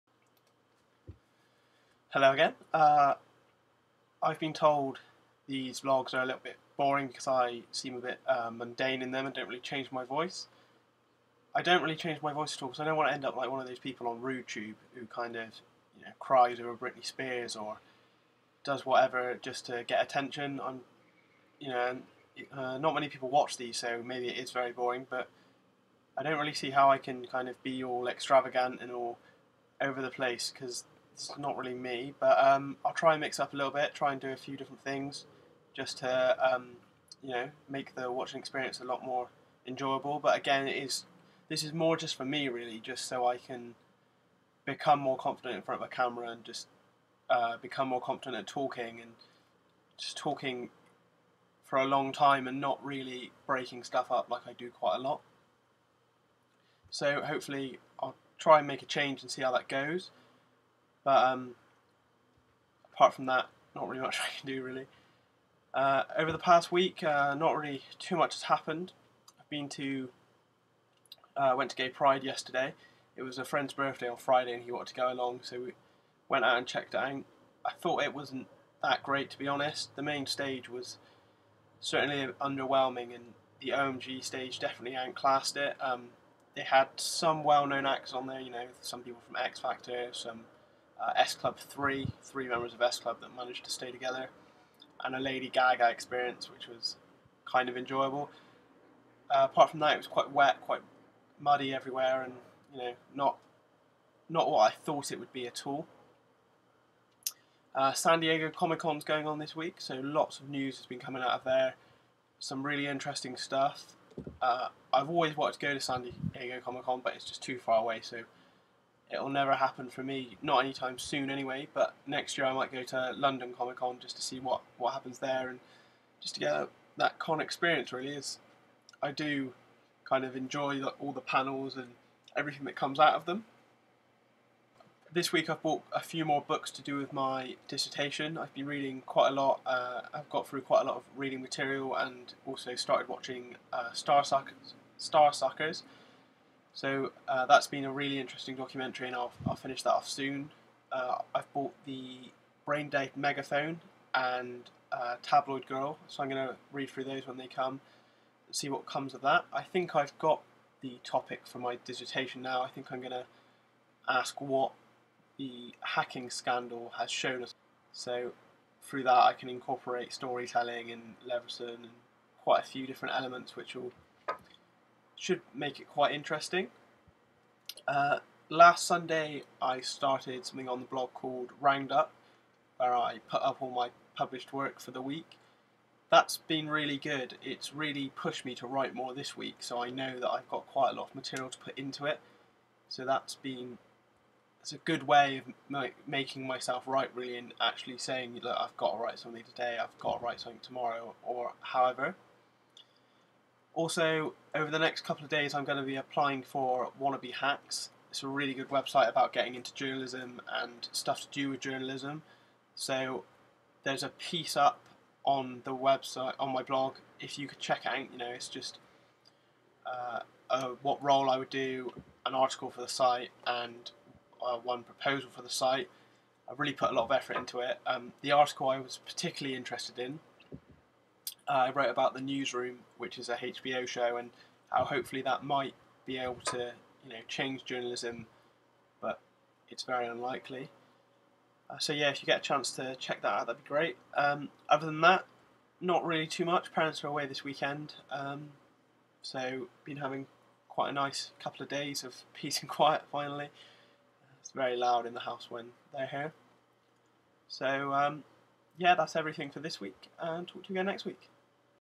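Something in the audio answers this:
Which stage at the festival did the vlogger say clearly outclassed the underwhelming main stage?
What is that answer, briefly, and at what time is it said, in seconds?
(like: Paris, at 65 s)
OMG stage, at 83 s.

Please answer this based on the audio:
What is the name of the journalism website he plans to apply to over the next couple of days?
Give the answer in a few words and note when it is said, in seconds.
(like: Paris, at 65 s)
Wannabe Hacks, at 206 s.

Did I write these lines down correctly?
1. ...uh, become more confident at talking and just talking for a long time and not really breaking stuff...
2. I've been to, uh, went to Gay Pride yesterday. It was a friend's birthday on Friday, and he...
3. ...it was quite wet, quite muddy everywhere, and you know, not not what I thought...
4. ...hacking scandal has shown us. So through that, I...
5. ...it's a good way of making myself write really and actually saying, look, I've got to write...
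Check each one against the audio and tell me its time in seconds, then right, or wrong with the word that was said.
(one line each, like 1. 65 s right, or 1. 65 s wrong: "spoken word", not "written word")
1. 47 s right
2. 69 s right
3. 99 s right
4. 165 s right
5. 194 s right.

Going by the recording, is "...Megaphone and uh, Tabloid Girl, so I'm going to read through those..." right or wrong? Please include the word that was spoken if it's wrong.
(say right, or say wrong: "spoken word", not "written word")
right.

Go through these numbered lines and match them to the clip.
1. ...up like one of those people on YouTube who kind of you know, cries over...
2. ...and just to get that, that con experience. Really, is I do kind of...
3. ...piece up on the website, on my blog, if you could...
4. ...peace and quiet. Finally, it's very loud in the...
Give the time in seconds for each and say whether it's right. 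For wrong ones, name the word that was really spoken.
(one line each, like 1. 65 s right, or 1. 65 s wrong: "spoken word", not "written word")
1. 13 s right
2. 125 s right
3. 214 s right
4. 252 s right.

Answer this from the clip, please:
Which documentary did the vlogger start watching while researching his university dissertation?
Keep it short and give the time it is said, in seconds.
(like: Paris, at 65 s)
Starsuckers, at 143 s.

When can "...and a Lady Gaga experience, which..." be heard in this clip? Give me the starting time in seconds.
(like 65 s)
95 s.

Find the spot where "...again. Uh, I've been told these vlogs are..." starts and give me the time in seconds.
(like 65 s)
2 s.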